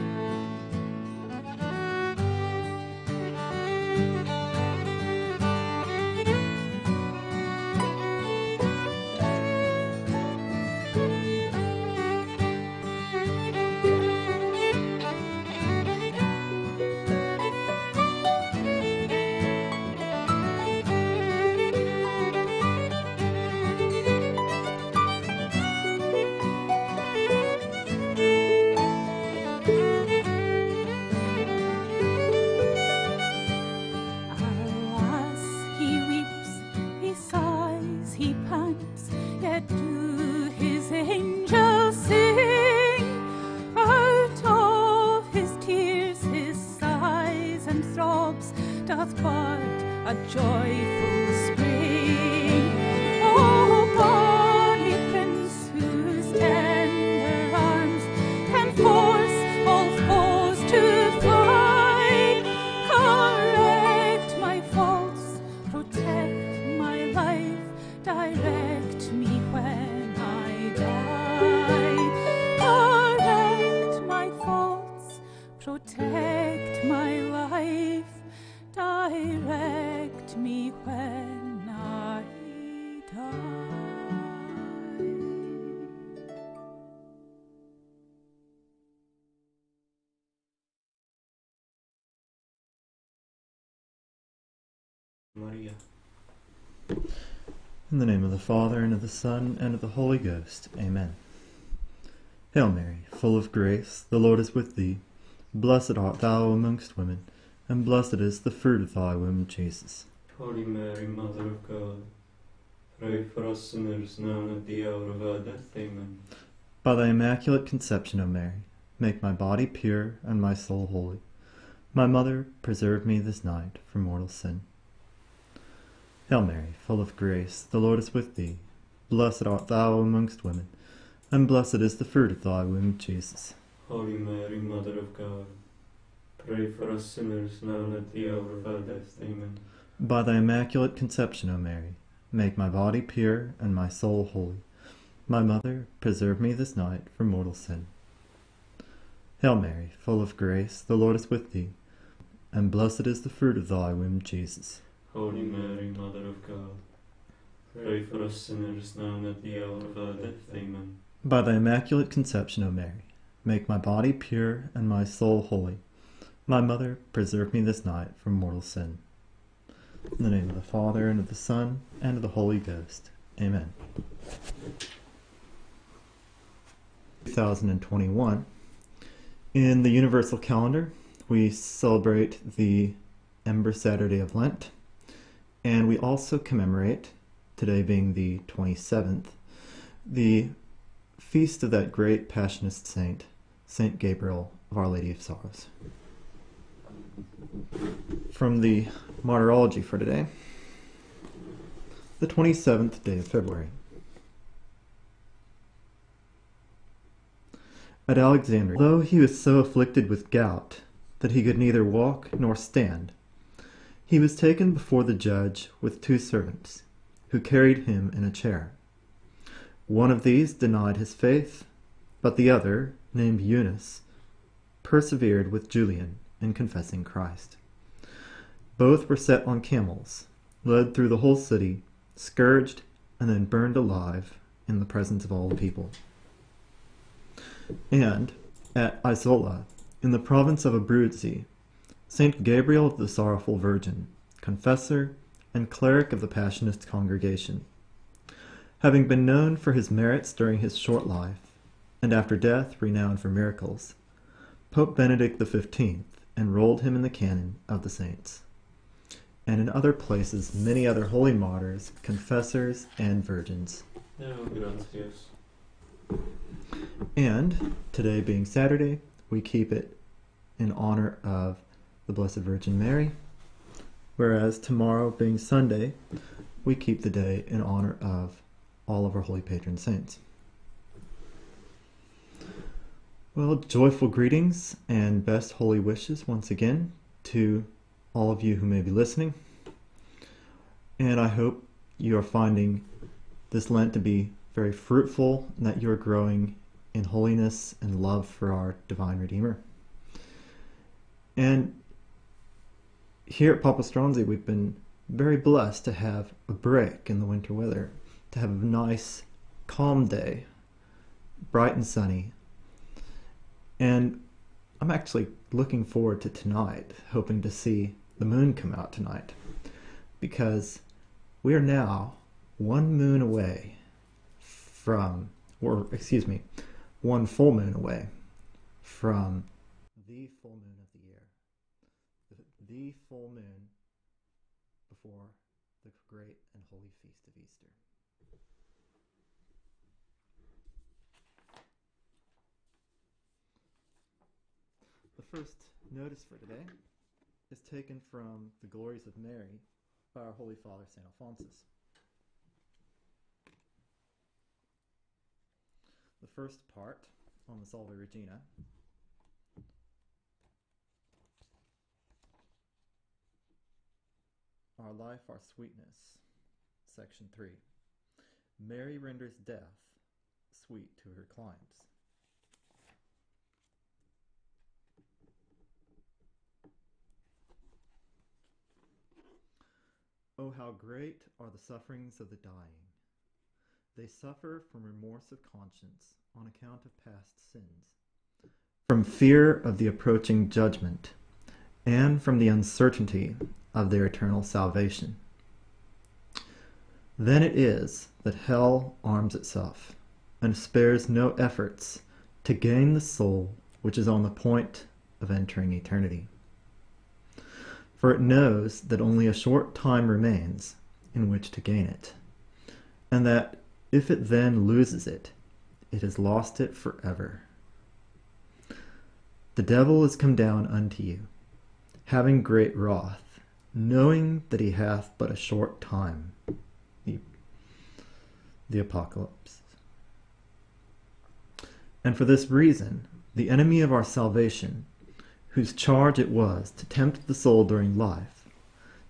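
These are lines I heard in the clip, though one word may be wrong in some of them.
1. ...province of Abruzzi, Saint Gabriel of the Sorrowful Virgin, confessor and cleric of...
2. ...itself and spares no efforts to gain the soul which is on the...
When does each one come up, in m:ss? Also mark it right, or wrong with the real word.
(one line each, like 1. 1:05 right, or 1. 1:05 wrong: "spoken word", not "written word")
1. 4:00 right
2. 6:39 right.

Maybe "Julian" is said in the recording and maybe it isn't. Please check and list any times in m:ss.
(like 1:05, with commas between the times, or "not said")
3:45.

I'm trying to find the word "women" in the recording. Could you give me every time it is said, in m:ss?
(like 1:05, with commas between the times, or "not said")
1:46, 2:10.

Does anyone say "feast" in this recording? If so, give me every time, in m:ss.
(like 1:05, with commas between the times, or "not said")
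3:11, 5:36.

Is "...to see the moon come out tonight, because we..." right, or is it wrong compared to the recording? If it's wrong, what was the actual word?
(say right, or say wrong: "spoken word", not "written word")
right.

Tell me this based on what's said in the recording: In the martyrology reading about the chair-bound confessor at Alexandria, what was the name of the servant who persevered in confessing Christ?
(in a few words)
Eunus.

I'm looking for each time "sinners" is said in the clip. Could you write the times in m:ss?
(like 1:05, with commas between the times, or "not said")
1:53, 2:17, 2:38.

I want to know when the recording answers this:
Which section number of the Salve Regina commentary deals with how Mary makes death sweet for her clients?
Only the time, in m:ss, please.
6:06.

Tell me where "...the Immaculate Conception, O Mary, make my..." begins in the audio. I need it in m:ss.
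2:41.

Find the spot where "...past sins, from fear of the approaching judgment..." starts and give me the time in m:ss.
6:26.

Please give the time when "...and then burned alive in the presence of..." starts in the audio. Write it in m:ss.
3:53.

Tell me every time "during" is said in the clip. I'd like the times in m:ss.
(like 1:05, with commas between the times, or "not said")
4:10, 7:17.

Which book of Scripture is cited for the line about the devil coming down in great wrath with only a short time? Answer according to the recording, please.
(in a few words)
The Apocalypse.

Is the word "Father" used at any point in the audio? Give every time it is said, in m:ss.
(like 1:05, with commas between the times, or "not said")
1:38, 2:50, 5:50.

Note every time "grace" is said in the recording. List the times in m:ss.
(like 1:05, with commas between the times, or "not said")
1:43, 2:07, 2:30.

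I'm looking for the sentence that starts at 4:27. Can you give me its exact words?
and today being Saturday, we keep it in honor of the Blessed Virgin Mary.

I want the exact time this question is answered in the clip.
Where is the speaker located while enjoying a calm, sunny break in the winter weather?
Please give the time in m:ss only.
5:03.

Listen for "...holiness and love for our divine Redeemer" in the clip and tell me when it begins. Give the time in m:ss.
4:57.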